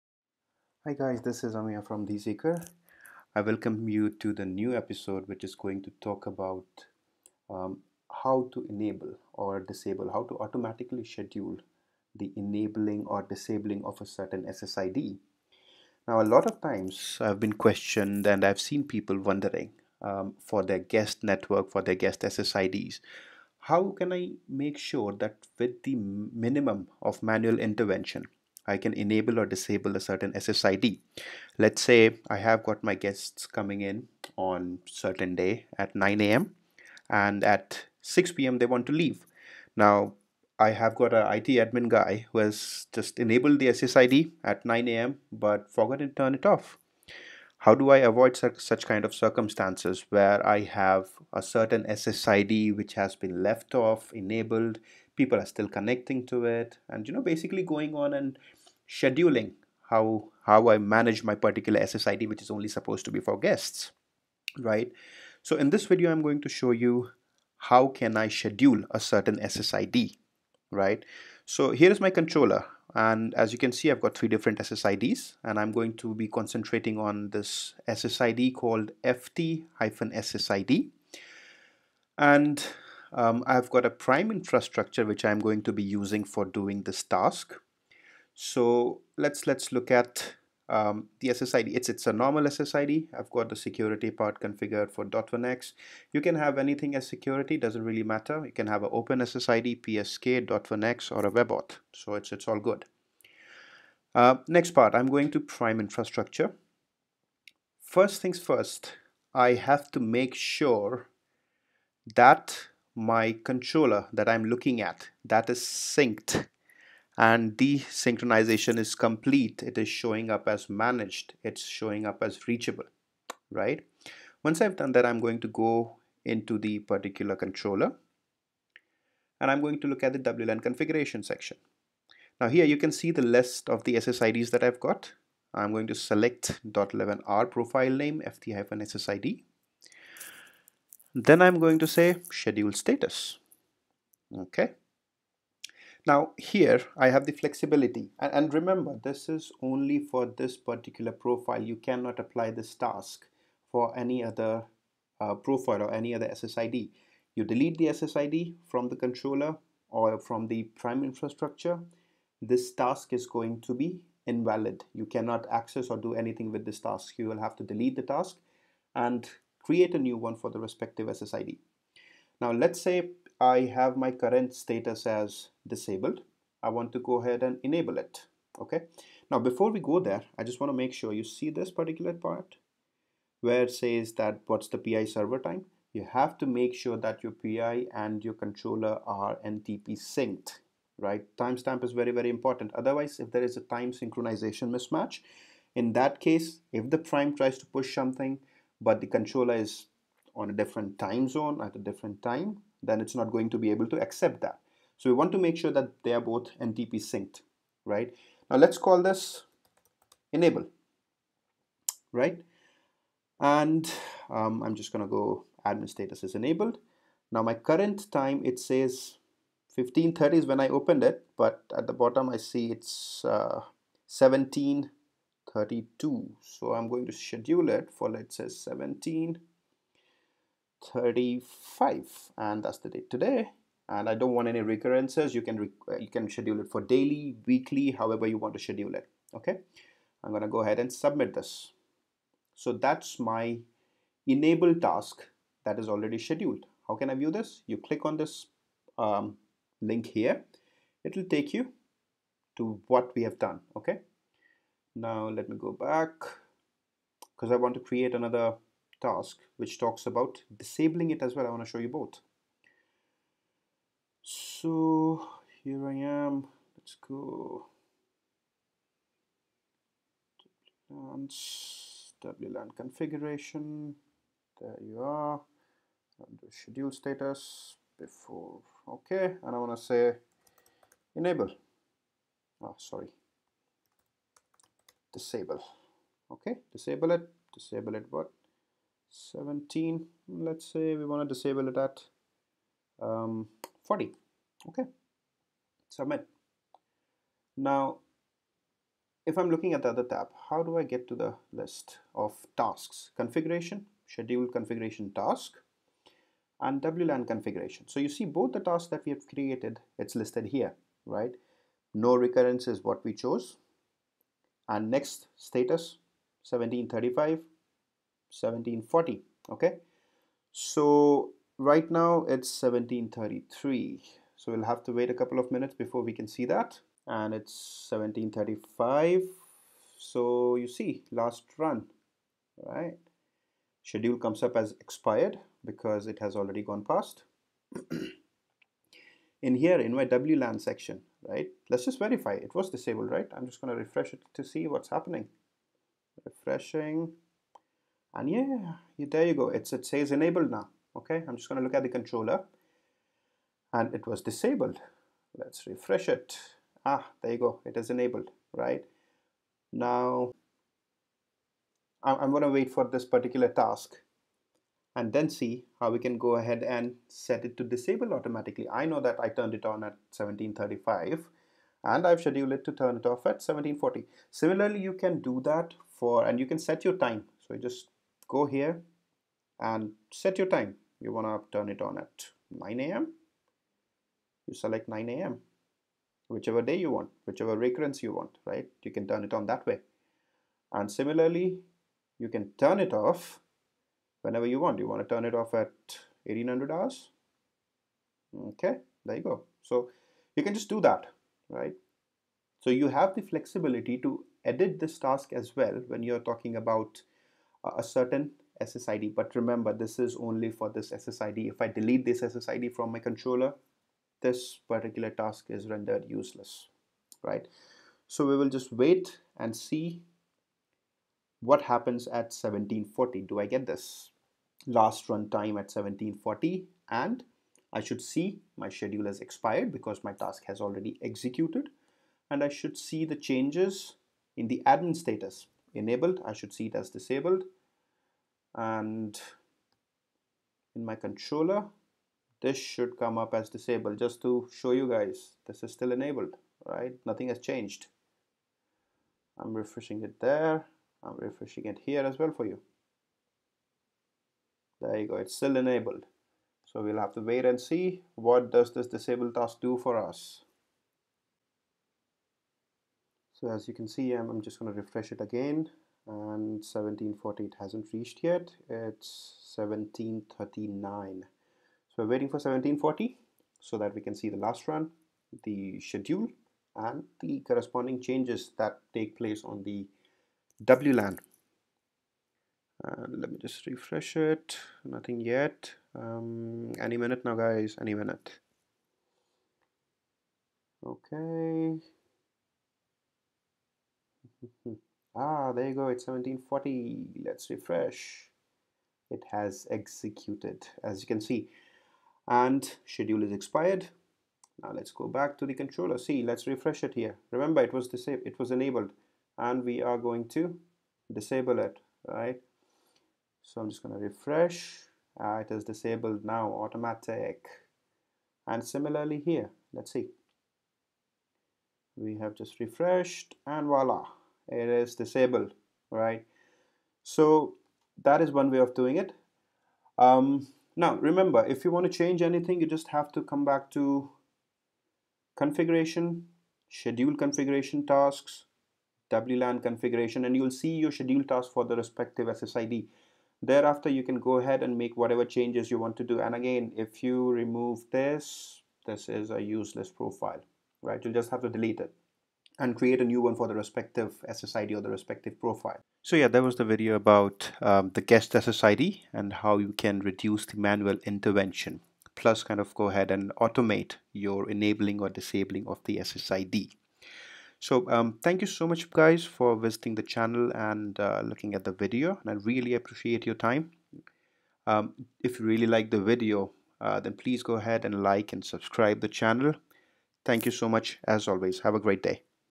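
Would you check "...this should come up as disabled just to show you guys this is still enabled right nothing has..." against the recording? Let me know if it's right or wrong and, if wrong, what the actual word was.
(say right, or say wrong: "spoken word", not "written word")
right.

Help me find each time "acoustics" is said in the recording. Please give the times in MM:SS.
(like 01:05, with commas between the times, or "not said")
not said.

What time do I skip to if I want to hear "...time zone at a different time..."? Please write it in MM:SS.
03:20.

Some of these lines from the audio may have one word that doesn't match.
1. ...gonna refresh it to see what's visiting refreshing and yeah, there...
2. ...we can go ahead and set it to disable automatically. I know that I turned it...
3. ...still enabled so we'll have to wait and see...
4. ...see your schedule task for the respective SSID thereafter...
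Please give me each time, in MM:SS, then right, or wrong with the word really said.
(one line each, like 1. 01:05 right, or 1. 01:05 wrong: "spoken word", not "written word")
1. 05:43 wrong: "happening", not "visiting"
2. 06:05 right
3. 07:35 right
4. 09:00 right.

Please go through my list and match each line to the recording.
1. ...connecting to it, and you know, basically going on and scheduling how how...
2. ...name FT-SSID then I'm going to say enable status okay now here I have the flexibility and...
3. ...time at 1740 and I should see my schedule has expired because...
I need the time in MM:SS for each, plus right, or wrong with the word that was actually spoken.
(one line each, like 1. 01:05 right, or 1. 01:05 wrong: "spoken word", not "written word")
1. 00:55 right
2. 02:17 wrong: "schedule", not "enable"
3. 07:05 right.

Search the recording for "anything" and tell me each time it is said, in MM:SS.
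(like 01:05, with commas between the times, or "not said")
01:36, 02:46, 08:52.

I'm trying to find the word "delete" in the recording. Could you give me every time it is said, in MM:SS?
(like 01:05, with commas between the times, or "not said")
02:37, 02:47, 06:51, 09:11.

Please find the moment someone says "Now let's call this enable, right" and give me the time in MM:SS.
03:28.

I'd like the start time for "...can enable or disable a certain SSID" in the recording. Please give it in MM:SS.
00:28.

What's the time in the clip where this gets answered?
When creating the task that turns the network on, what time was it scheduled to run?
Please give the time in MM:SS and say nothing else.
03:48.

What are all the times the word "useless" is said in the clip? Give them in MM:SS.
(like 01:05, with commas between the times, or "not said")
06:56, 09:09.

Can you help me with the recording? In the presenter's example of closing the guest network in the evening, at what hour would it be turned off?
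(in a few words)
1800 hours.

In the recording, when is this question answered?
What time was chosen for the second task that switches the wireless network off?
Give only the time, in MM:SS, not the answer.
04:53.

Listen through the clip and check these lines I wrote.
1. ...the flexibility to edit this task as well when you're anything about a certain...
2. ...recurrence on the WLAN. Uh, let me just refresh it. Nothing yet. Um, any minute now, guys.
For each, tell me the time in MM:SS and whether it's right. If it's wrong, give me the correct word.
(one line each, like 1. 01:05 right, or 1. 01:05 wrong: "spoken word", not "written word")
1. 06:43 wrong: "talking", not "anything"
2. 07:59 wrong: "place", not "recurrence".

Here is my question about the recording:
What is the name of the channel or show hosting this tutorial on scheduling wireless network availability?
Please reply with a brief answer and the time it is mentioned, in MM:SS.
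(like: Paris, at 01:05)
The Seeker, at 00:02.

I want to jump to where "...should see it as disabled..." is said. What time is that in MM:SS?
07:16.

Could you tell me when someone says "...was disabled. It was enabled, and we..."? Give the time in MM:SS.
08:27.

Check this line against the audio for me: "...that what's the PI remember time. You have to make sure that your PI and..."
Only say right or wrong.
wrong.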